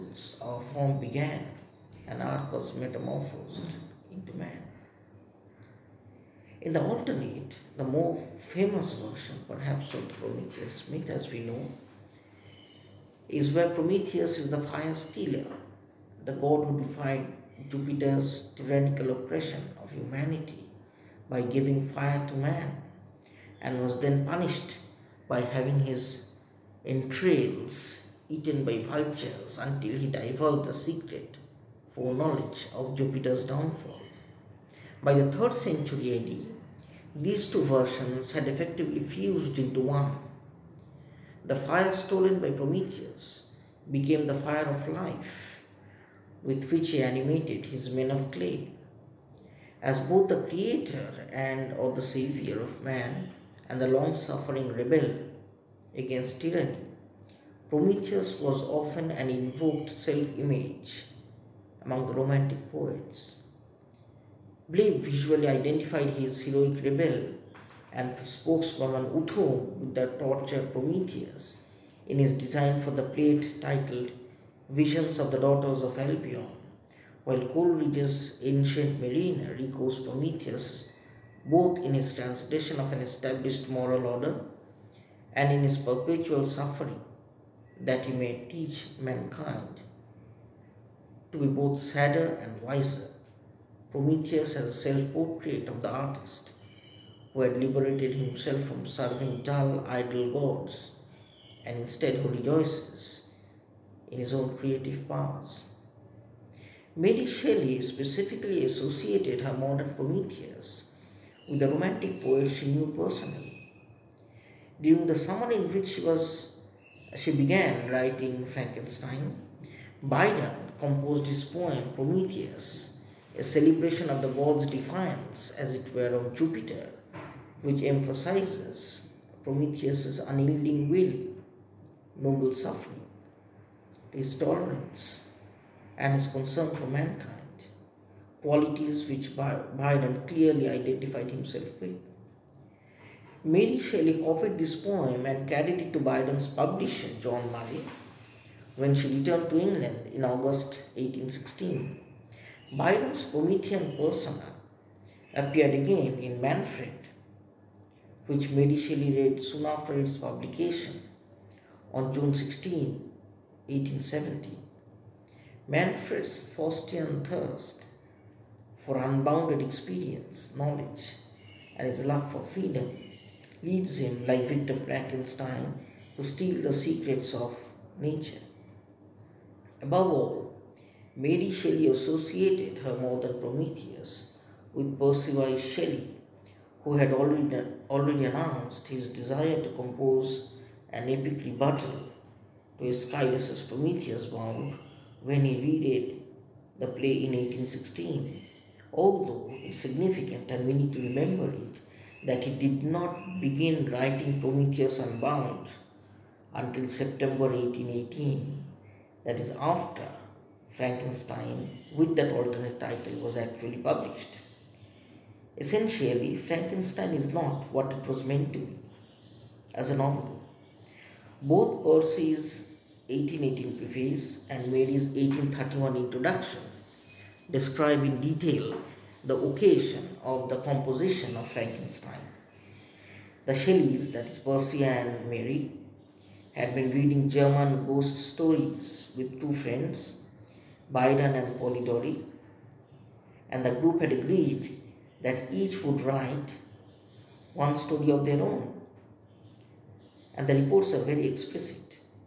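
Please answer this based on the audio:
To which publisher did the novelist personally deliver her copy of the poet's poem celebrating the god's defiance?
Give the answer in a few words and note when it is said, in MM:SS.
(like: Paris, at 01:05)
John Murray, at 02:27.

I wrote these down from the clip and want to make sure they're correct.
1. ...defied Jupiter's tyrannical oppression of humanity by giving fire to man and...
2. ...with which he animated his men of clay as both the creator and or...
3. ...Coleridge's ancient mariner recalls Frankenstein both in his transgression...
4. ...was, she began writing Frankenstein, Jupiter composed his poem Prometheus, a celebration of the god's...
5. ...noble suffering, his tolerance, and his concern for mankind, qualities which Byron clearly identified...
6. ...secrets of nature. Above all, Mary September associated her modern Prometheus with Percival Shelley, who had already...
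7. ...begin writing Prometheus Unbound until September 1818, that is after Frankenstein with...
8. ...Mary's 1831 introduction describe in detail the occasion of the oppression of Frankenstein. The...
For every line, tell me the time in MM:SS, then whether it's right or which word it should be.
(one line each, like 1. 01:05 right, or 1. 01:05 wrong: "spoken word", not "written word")
1. 00:16 right
2. 00:46 right
3. 01:17 wrong: "Prometheus", not "Frankenstein"
4. 01:56 wrong: "Byron", not "Jupiter"
5. 02:12 right
6. 02:56 wrong: "Shelley", not "September"
7. 03:23 right
8. 03:44 wrong: "composition", not "oppression".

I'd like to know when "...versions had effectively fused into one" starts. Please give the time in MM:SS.
00:37.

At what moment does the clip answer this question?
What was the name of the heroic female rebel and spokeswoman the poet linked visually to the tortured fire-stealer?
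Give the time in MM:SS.
01:09.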